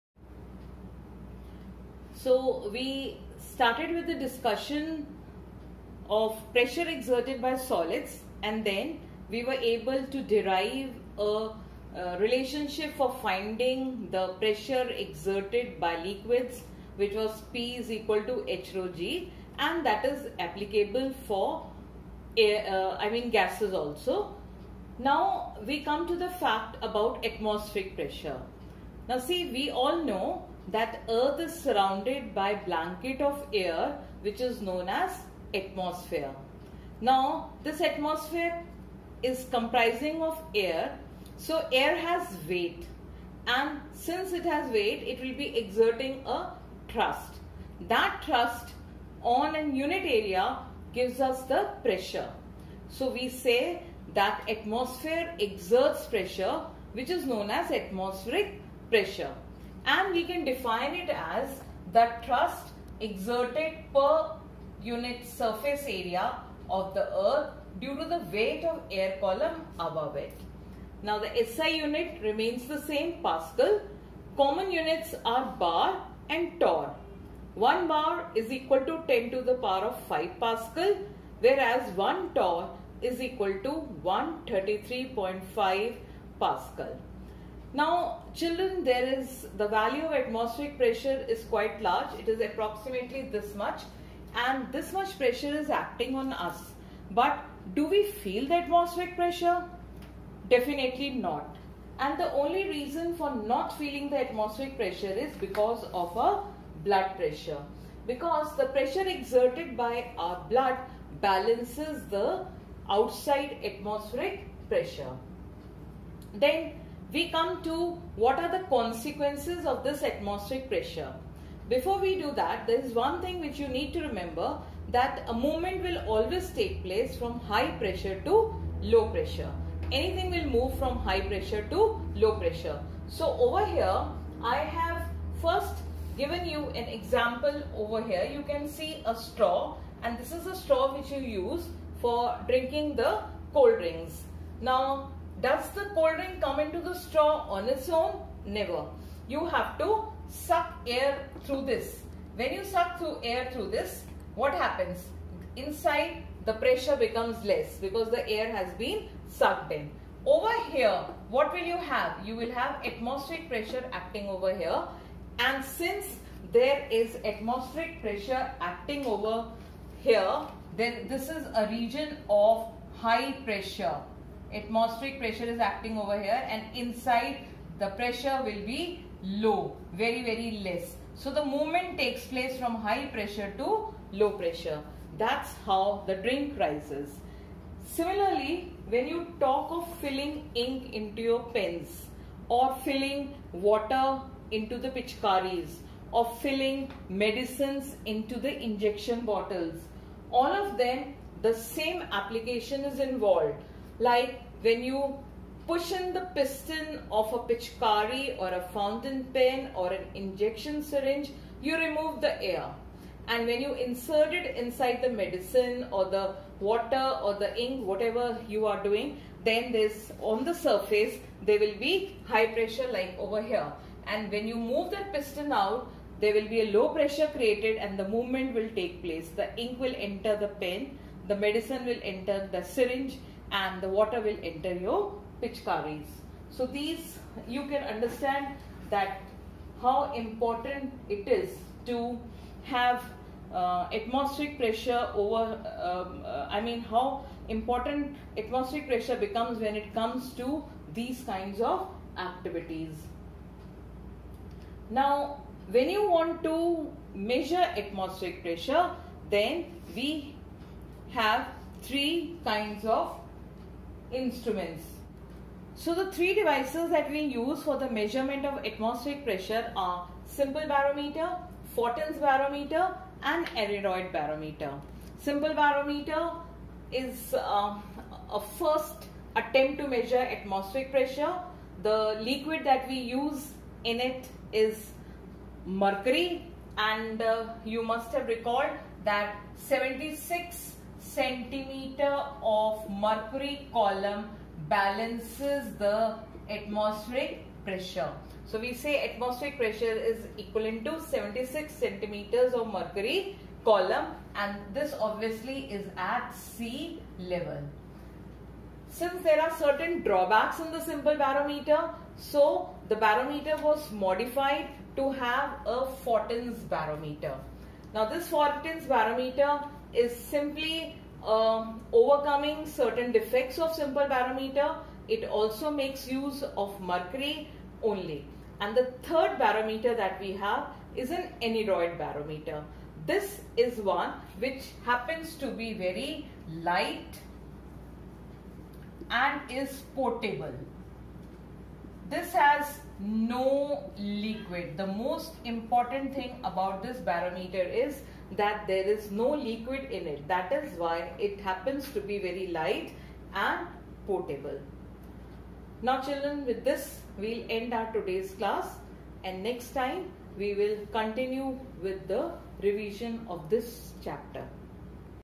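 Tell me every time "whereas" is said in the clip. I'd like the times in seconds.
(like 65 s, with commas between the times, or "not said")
81 s.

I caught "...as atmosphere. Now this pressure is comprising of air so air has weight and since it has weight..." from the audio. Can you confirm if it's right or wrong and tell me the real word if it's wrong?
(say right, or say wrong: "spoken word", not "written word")
wrong: "atmosphere", not "pressure".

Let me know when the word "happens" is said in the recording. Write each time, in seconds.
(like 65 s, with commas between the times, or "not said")
154 s, 334 s, 351 s.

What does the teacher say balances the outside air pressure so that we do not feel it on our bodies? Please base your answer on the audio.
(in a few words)
blood pressure.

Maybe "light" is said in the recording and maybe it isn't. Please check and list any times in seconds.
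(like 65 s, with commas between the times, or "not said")
336 s, 352 s.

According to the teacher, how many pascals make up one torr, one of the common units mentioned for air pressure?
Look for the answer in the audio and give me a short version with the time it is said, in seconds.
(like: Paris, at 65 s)
133.5, at 84 s.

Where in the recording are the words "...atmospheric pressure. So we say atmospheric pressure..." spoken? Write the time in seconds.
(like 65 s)
296 s.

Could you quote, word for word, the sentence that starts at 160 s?
Over here, what will you have?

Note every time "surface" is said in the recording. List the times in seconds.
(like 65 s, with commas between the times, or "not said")
65 s, 220 s.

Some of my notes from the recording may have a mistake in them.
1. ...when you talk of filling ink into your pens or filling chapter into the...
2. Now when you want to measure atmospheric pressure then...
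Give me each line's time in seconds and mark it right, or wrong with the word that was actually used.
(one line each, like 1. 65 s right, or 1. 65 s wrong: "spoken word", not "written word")
1. 188 s wrong: "water", not "chapter"
2. 254 s right.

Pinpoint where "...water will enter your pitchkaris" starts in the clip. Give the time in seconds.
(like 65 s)
233 s.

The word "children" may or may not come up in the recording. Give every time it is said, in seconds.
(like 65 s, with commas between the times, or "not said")
88 s, 356 s.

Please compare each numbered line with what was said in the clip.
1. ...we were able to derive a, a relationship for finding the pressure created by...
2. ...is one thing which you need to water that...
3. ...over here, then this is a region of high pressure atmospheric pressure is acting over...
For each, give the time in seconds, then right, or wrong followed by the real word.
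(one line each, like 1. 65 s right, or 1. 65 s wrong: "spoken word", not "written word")
1. 9 s wrong: "exerted", not "created"
2. 122 s wrong: "remember", not "water"
3. 169 s right.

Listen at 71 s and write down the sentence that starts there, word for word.
Now the SI unit remains the same Pascal.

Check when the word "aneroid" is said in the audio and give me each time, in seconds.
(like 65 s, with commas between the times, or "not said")
273 s, 331 s.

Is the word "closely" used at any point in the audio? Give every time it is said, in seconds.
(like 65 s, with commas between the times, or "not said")
not said.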